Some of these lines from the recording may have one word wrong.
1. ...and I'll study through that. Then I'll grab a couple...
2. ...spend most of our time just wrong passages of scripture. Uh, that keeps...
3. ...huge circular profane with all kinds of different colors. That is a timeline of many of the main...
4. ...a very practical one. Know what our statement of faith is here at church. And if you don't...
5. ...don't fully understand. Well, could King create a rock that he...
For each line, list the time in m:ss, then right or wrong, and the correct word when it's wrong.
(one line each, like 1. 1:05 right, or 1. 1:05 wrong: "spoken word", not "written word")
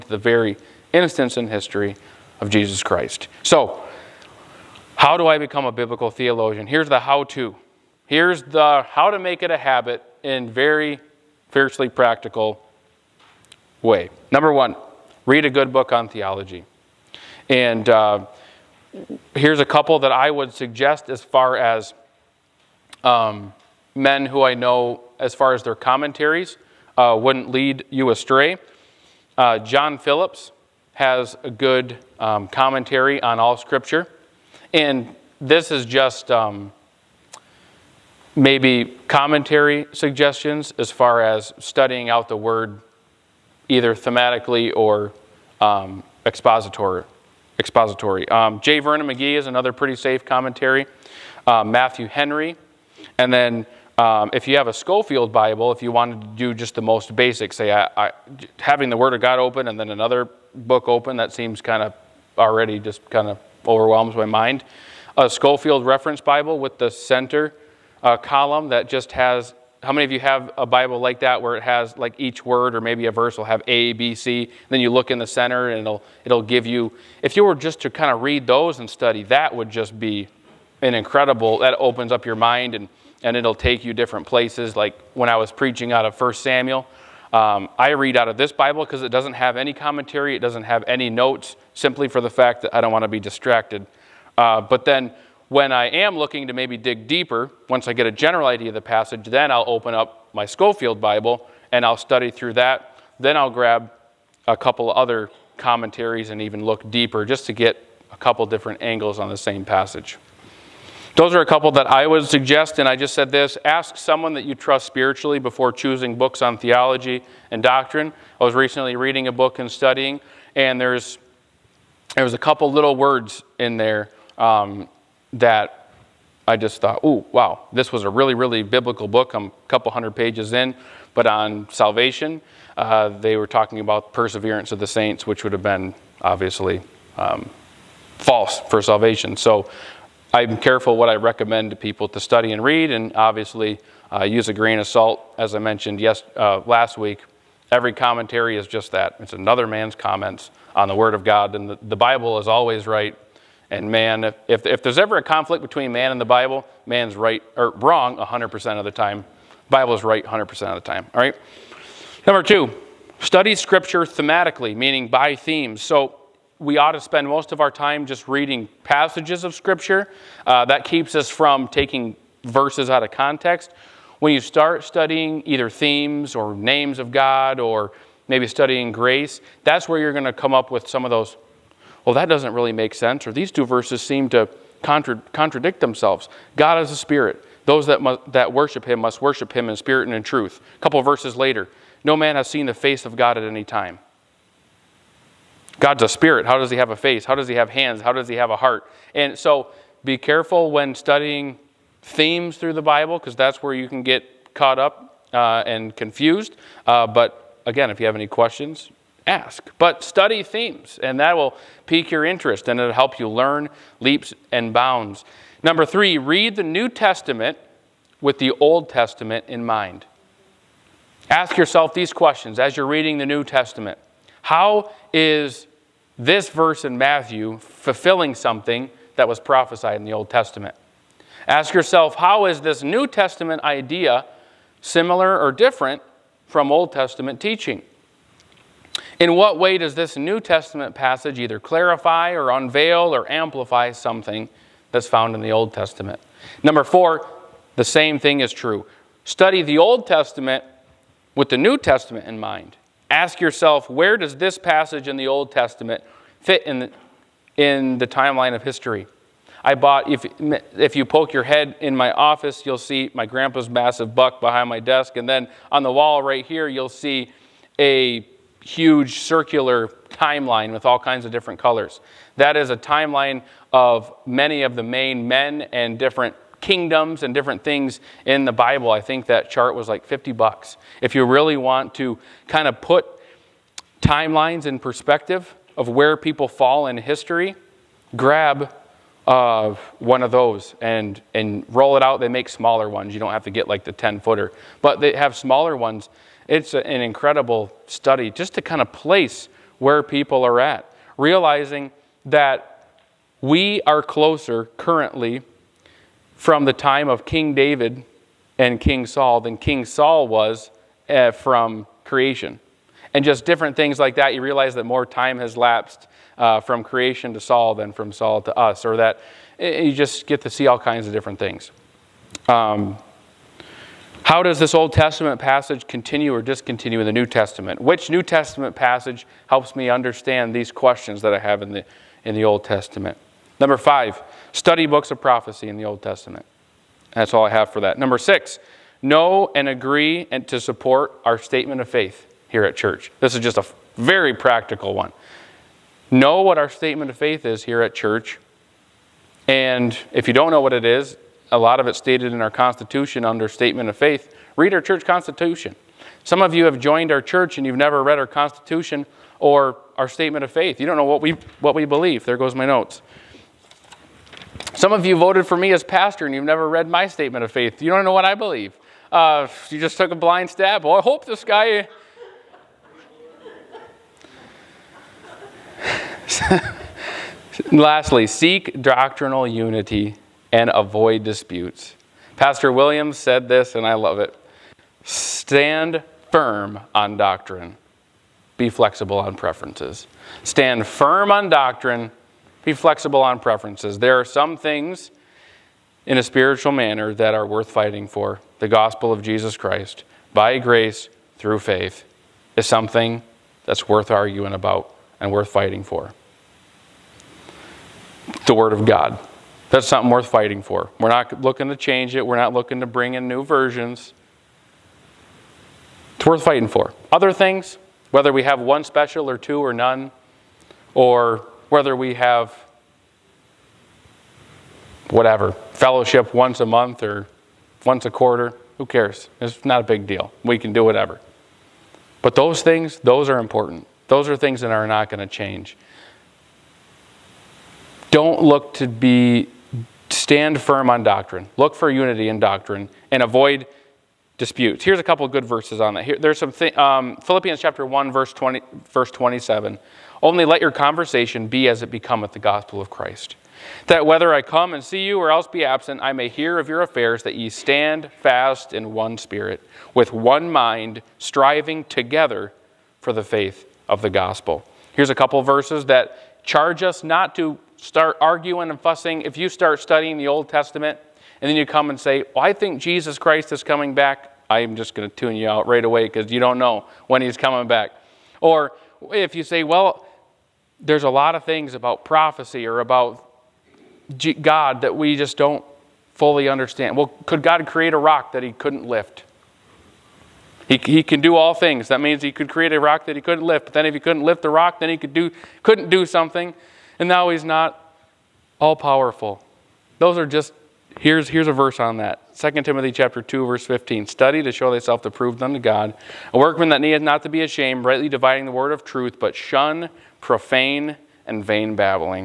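1. 1:41 right
2. 2:46 wrong: "reading", not "wrong"
3. 4:28 wrong: "timeline", not "profane"
4. 5:43 right
5. 8:05 wrong: "God", not "King".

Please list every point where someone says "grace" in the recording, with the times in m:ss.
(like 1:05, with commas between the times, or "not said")
2:58, 6:40.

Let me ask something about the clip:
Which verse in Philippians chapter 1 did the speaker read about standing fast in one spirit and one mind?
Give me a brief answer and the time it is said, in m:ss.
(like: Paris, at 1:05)
verse 27, at 7:28.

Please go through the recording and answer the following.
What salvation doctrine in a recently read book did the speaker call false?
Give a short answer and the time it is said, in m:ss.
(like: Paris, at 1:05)
perseverance of the saints, at 2:14.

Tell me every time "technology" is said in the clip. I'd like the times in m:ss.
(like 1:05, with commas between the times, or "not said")
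not said.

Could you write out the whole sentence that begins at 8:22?
2 Timothy chapter 2 verse 15.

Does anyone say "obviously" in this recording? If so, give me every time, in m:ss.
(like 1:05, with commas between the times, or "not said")
2:16, 2:23.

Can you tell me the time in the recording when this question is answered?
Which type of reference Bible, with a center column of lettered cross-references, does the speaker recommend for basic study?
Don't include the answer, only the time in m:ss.
1:05.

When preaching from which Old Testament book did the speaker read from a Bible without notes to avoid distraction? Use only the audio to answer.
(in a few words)
1 Samuel.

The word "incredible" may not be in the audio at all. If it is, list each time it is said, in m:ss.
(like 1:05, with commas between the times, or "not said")
1:20, 4:57.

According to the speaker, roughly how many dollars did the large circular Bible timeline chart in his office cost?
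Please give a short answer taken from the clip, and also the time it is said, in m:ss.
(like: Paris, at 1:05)
50, at 4:40.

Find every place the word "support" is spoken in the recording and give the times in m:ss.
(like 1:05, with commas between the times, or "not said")
5:40.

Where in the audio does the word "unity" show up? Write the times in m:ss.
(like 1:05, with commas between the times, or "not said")
6:19, 7:21.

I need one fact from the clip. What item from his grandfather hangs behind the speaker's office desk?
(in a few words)
massive buck.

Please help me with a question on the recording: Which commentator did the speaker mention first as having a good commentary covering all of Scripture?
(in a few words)
John Phillips.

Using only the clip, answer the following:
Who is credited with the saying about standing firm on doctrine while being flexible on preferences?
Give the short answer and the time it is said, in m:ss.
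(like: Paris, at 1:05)
Pastor Williams, at 6:22.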